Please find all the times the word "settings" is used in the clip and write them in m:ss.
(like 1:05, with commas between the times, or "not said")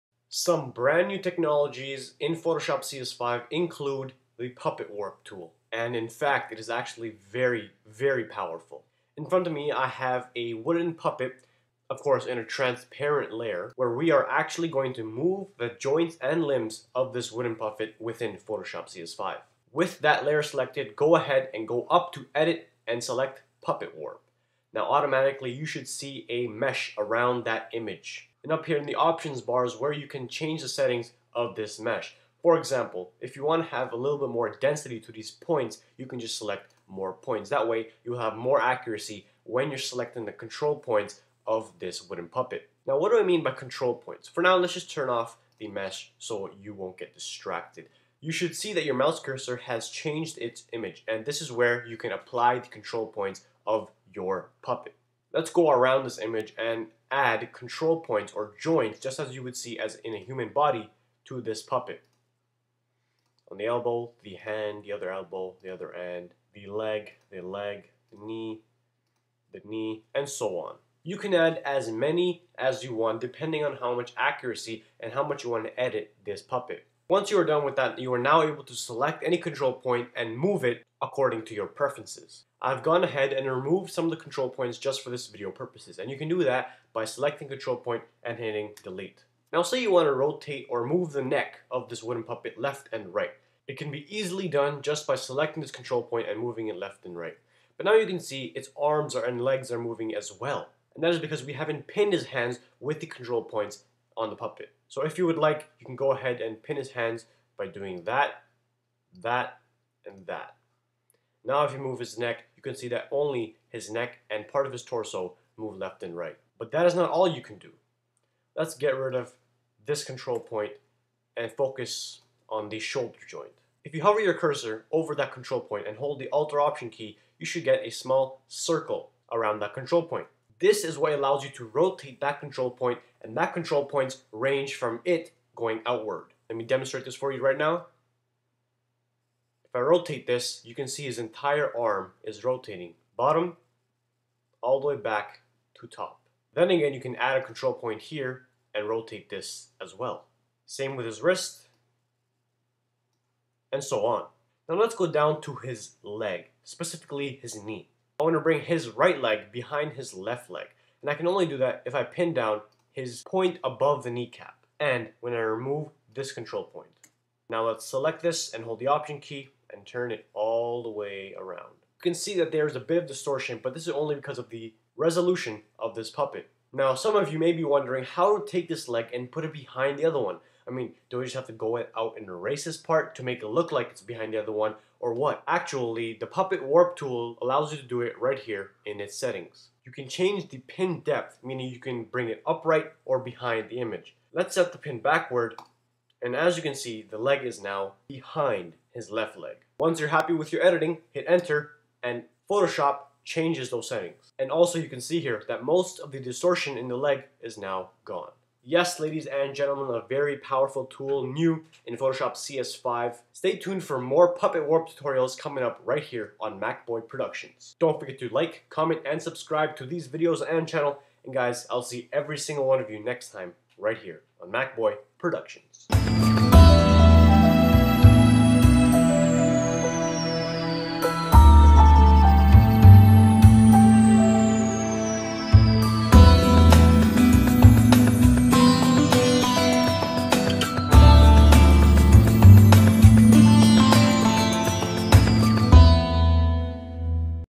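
0:30, 3:09, 3:23.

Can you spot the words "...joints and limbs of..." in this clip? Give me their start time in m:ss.
0:15.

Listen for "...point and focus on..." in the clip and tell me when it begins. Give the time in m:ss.
2:00.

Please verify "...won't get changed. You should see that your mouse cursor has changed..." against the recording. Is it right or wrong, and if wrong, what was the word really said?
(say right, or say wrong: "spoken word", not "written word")
wrong: "distracted", not "changed".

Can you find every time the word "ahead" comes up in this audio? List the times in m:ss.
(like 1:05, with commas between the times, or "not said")
0:21, 1:23, 1:46.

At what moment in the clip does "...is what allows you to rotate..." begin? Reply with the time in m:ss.
2:10.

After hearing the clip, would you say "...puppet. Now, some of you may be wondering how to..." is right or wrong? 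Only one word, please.
right.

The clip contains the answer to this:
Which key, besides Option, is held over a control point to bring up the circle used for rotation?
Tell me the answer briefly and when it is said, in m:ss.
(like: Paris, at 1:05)
Alt, at 2:06.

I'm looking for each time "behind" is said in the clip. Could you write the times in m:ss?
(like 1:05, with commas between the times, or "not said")
2:39, 2:59, 3:04, 3:13, 3:18.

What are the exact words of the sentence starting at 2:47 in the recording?
Now let's select this and hold the option key and turn it all the way around.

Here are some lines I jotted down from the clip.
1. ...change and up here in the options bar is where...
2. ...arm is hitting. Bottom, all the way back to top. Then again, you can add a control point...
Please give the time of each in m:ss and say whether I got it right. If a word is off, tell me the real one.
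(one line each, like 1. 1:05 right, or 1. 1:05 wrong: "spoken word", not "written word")
1. 0:27 wrong: "image", not "change"
2. 2:21 wrong: "rotating", not "hitting".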